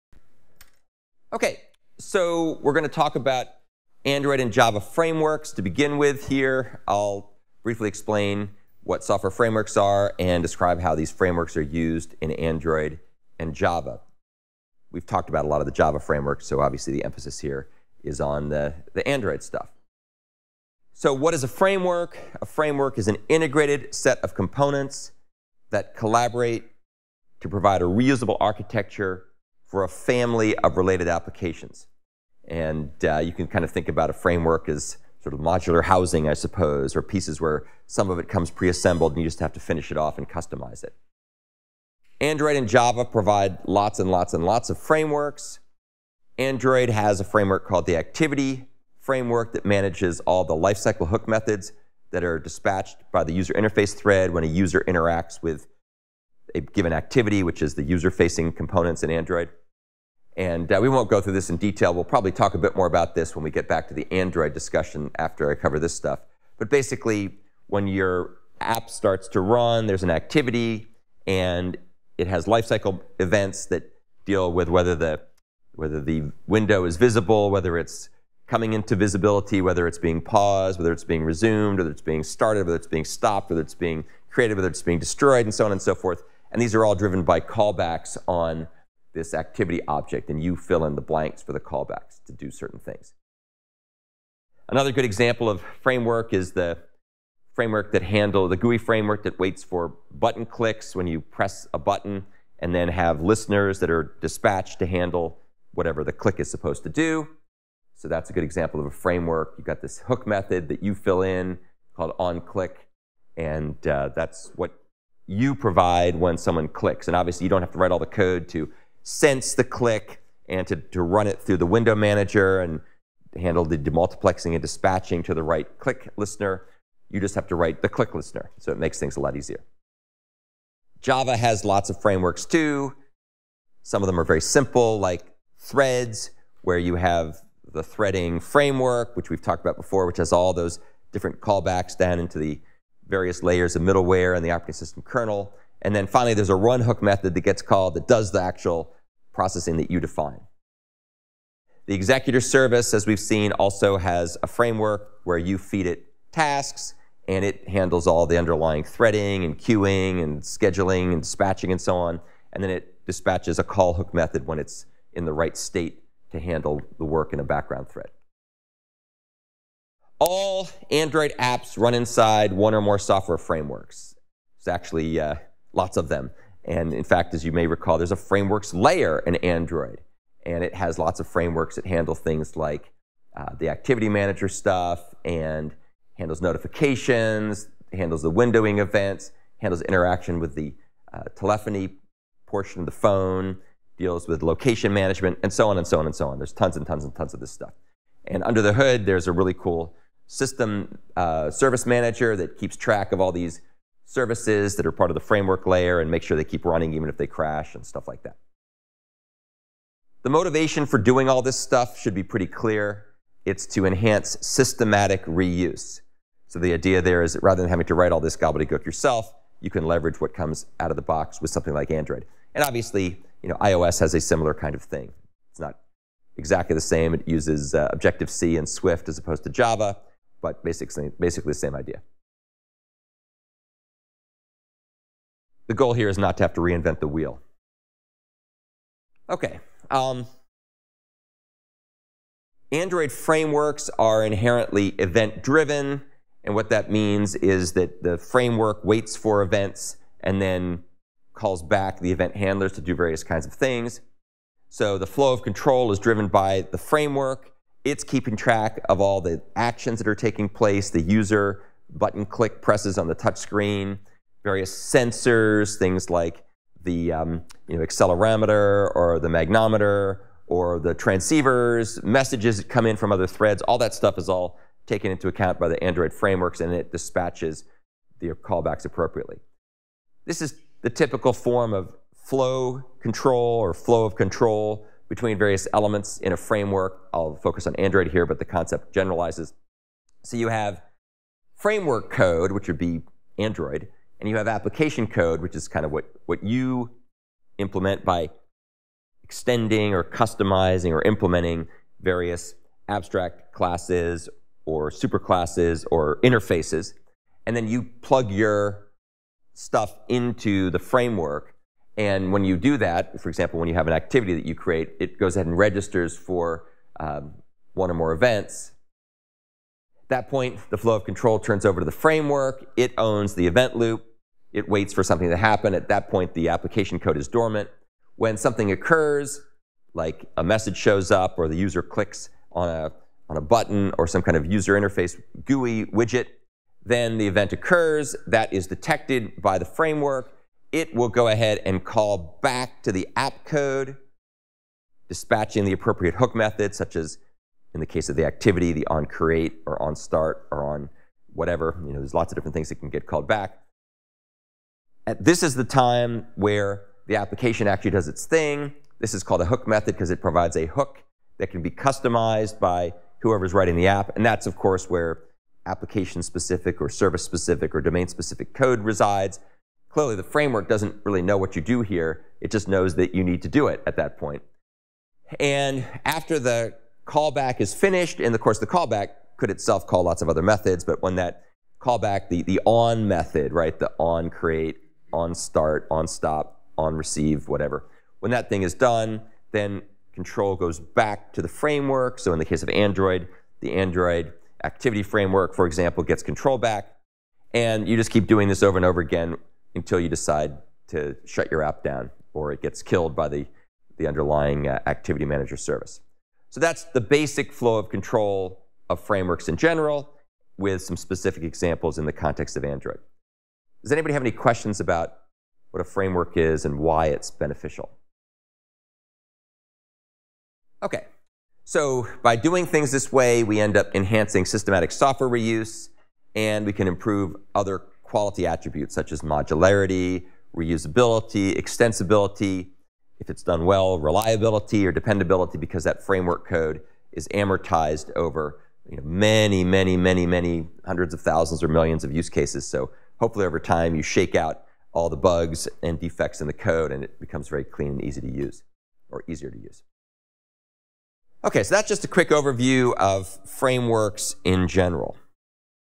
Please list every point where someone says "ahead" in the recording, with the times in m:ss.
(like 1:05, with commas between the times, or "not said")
5:15, 5:41.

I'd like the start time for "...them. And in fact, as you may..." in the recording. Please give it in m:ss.
2:56.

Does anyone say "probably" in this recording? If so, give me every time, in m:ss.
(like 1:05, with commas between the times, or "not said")
1:02.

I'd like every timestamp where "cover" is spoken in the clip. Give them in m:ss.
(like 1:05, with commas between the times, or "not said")
1:05.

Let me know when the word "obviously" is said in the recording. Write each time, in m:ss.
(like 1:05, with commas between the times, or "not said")
0:16, 1:57, 3:42.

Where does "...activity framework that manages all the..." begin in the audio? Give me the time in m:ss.
0:47.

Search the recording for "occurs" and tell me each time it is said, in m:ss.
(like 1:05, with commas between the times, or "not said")
5:28, 5:37.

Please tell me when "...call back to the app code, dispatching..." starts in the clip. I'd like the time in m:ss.
5:41.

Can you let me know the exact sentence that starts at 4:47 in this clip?
I'll focus on Android here, but the concept generalizes.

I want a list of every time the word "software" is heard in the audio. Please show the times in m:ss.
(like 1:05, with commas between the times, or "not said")
0:09, 2:52, 7:04.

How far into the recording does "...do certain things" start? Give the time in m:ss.
1:32.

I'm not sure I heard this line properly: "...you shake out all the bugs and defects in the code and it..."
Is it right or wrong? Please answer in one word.
right.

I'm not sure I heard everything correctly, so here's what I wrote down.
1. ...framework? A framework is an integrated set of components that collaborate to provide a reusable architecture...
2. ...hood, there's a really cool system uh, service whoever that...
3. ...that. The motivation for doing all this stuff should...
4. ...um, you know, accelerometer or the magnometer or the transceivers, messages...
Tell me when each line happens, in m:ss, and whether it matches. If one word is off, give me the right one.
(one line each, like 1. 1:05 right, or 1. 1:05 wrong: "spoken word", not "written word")
1. 0:21 right
2. 3:18 wrong: "manager", not "whoever"
3. 3:28 right
4. 4:27 right.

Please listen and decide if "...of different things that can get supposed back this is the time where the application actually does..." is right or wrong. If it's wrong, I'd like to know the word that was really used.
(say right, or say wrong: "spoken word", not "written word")
wrong: "called", not "supposed".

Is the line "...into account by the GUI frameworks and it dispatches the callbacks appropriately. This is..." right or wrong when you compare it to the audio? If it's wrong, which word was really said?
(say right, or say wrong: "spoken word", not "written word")
wrong: "Android", not "GUI".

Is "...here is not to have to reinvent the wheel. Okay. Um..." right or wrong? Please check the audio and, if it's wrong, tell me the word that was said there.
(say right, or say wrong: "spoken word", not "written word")
right.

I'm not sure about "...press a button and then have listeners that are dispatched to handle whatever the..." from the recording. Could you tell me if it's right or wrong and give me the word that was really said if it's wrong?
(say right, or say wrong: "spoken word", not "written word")
right.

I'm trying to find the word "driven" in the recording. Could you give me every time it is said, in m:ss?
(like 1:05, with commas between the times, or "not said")
1:26, 4:04, 4:15.